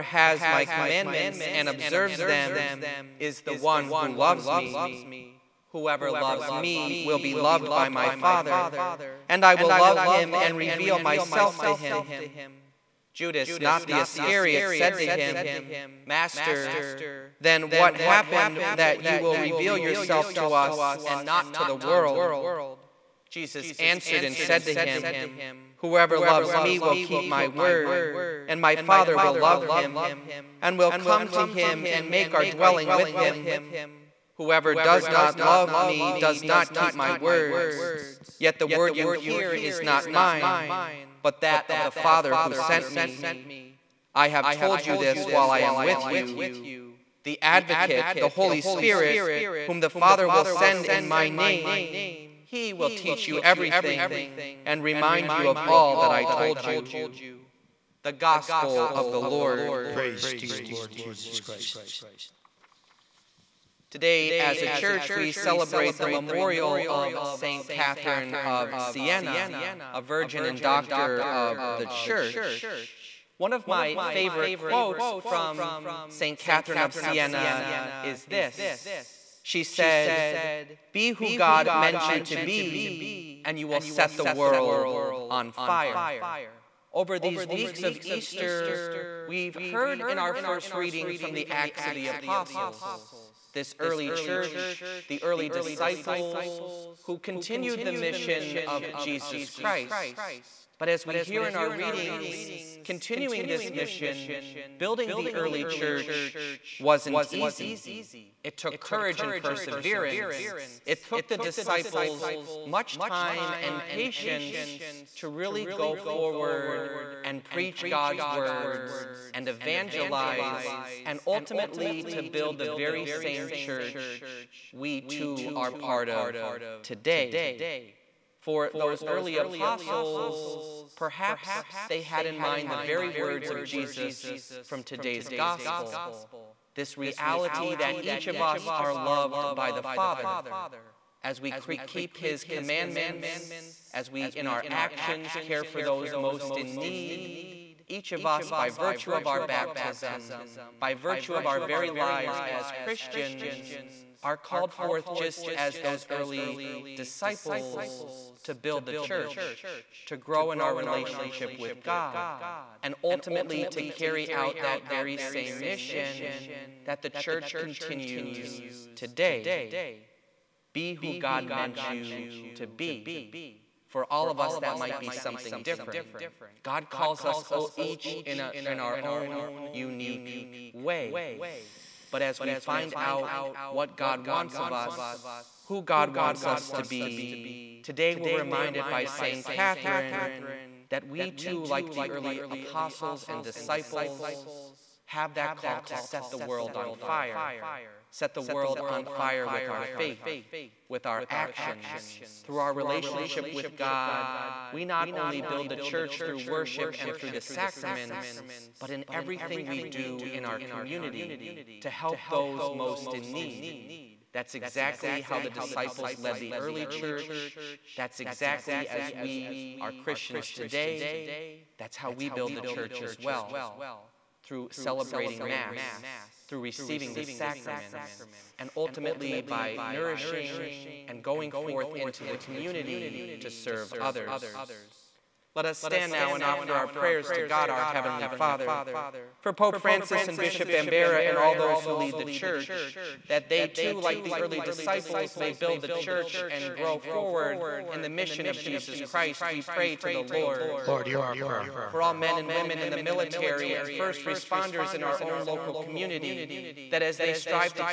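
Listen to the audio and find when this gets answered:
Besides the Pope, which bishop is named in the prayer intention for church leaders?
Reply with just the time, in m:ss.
4:00.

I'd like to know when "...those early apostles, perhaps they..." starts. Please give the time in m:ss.
2:08.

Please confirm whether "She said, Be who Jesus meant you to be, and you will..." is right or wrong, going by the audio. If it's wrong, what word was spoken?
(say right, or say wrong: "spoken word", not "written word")
wrong: "God", not "Jesus".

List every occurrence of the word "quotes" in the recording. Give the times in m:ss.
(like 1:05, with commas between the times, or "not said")
1:14.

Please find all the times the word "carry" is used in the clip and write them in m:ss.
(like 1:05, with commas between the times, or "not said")
2:43.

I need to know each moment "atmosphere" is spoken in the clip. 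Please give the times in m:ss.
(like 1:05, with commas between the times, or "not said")
not said.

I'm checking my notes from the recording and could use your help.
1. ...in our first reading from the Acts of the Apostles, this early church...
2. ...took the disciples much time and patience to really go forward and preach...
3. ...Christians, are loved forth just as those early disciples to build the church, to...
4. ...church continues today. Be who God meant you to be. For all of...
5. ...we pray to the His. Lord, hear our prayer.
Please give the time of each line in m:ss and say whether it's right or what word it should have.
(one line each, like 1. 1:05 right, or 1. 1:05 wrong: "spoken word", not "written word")
1. 1:30 right
2. 1:51 right
3. 2:32 wrong: "called", not "loved"
4. 2:47 right
5. 4:09 wrong: "Lord", not "His".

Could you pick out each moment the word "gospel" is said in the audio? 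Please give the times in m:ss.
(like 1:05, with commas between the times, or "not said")
0:58, 2:15.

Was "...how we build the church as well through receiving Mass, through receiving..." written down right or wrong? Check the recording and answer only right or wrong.
wrong.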